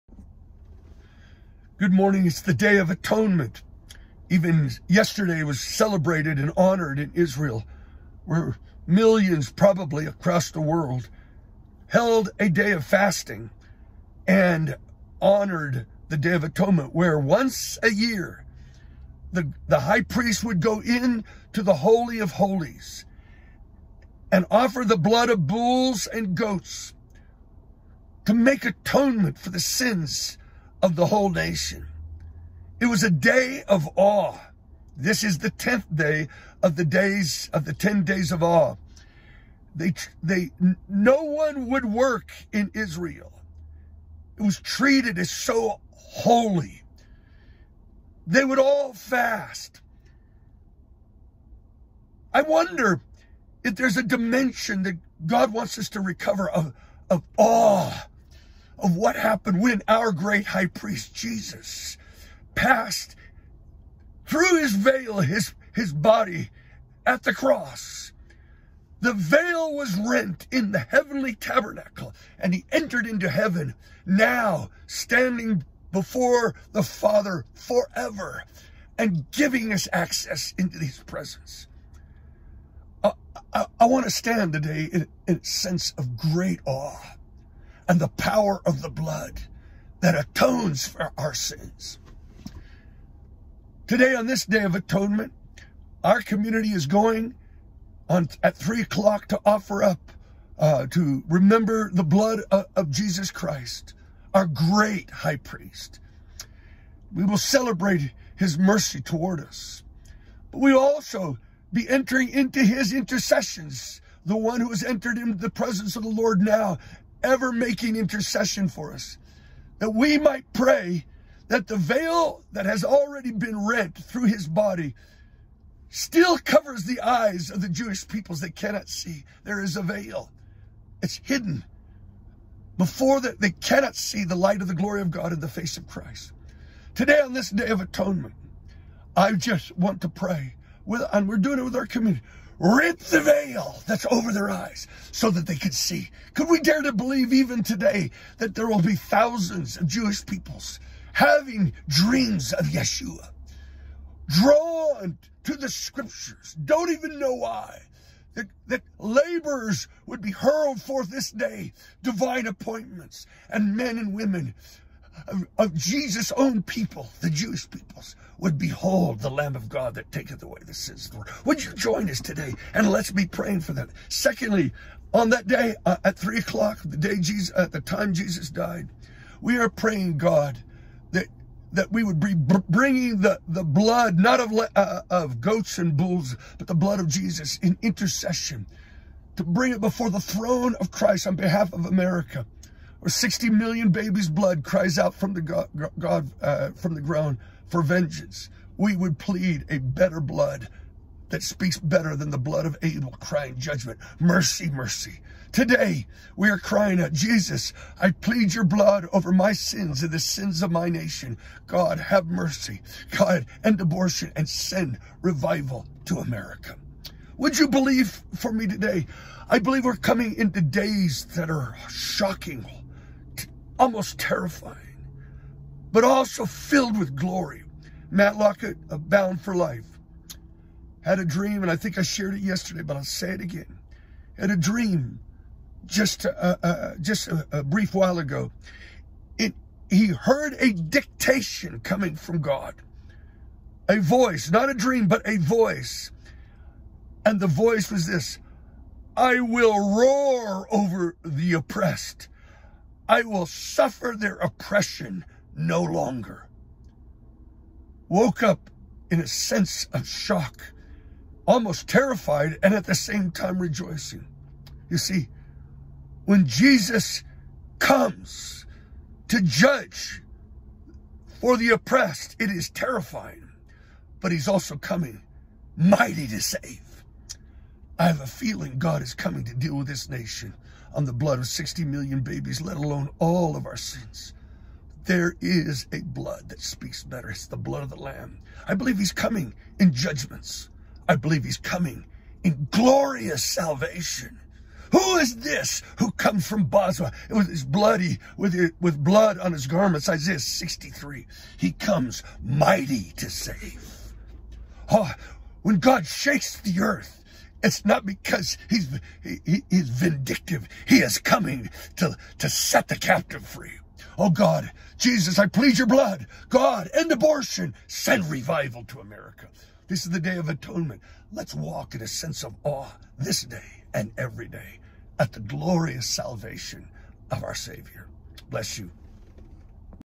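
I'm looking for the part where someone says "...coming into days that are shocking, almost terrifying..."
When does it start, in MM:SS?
03:39.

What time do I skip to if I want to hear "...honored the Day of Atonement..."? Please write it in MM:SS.
00:15.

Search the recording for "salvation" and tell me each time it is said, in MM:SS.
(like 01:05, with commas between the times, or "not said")
04:53, 05:26.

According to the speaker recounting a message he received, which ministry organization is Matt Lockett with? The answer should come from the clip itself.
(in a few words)
Bound for Life.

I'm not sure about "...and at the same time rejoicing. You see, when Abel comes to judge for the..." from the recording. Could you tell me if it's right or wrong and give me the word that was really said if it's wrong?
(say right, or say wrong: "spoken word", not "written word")
wrong: "Jesus", not "Abel".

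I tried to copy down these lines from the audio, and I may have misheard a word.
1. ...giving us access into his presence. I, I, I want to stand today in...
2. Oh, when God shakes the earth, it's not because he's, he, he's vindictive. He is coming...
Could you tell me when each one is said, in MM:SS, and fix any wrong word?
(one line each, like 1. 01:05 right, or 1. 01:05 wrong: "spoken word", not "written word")
1. 01:19 right
2. 05:04 right.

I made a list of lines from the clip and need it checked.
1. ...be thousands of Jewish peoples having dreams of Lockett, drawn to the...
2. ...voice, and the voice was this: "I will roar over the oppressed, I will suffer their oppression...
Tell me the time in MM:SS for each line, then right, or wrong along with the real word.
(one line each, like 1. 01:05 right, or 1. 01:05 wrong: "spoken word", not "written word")
1. 02:28 wrong: "Yeshua", not "Lockett"
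2. 04:05 right.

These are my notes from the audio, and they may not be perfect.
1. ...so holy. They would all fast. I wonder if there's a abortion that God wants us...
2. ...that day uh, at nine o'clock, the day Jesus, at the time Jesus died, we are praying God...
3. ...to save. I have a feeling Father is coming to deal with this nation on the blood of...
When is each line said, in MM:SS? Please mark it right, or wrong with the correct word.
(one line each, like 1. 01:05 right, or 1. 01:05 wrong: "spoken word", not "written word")
1. 00:45 wrong: "dimension", not "abortion"
2. 02:55 wrong: "three", not "nine"
3. 04:36 wrong: "God", not "Father".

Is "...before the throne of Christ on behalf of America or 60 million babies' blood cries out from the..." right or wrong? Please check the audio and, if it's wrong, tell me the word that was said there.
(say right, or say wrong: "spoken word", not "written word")
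right.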